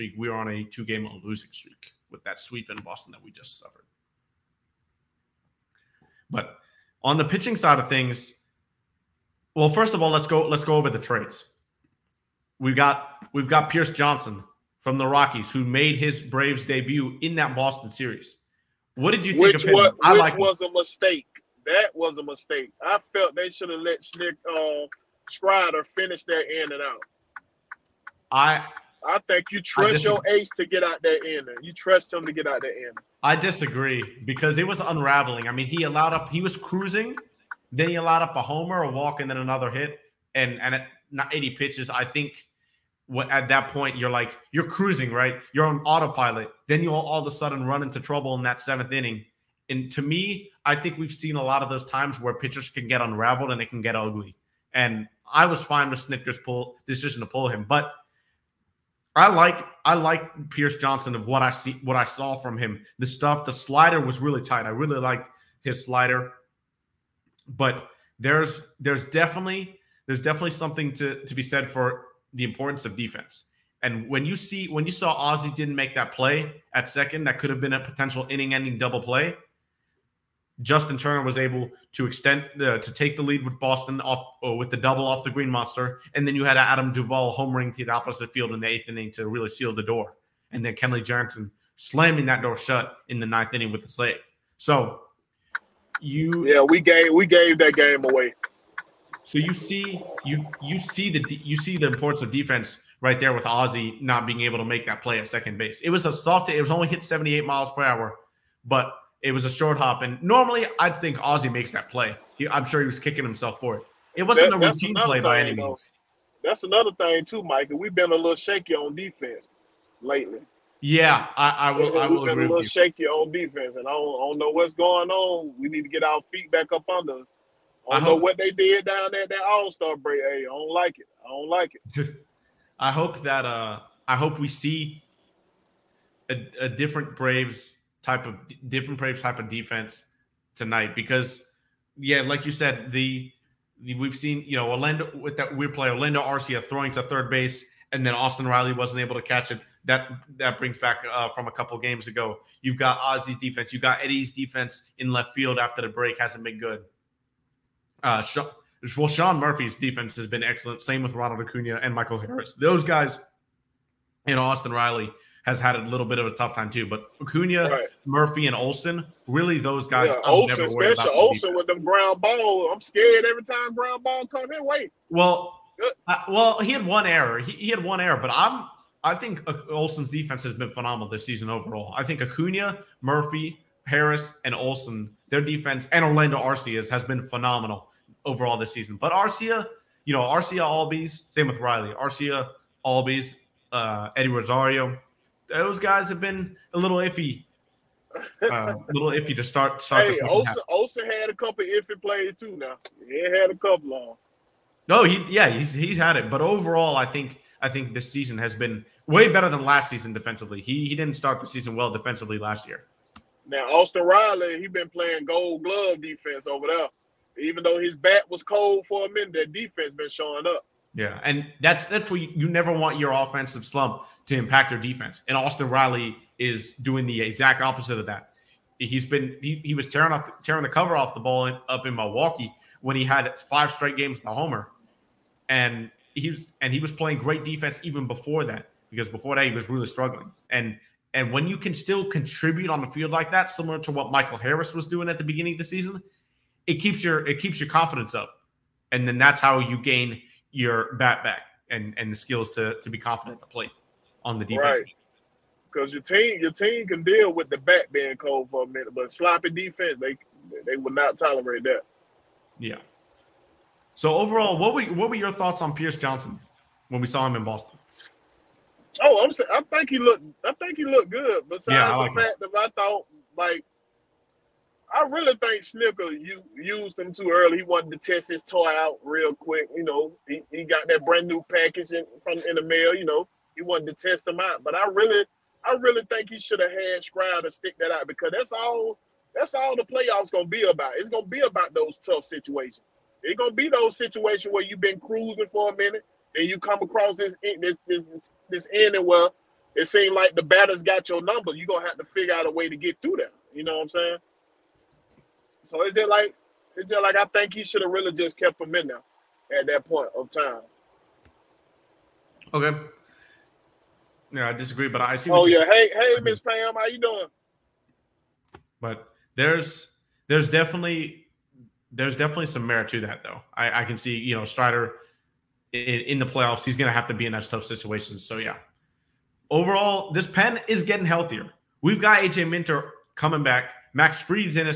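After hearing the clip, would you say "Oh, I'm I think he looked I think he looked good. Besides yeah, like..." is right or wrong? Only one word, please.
right.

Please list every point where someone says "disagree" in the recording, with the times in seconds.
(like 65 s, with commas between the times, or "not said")
33 s, 314 s.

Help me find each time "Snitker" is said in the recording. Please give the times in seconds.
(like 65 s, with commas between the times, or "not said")
55 s, 275 s.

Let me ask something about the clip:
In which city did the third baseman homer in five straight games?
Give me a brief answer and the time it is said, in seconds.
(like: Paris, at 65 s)
Milwaukee, at 231 s.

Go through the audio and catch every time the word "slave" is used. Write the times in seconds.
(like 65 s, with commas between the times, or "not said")
93 s.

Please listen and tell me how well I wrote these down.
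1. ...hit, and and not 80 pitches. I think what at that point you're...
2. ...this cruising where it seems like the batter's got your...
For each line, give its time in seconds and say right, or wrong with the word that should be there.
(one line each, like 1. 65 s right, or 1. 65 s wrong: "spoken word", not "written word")
1. 39 s right
2. 298 s wrong: "ending", not "cruising".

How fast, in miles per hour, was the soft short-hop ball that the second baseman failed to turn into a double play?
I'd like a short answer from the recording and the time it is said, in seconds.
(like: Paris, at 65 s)
78, at 107 s.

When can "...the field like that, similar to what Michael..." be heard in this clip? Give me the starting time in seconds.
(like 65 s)
242 s.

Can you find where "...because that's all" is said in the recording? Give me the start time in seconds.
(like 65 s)
288 s.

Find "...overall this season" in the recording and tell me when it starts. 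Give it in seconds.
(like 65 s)
188 s.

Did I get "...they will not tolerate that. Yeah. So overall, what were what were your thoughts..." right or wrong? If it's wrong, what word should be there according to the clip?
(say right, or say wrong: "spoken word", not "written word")
right.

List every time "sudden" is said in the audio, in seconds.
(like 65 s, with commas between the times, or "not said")
47 s.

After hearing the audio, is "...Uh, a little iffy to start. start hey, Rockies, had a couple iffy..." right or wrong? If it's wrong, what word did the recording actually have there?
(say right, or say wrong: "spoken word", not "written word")
wrong: "Osa", not "Rockies".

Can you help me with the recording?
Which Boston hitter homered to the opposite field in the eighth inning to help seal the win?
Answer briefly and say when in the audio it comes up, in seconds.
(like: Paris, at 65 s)
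Adam Duvall, at 86 s.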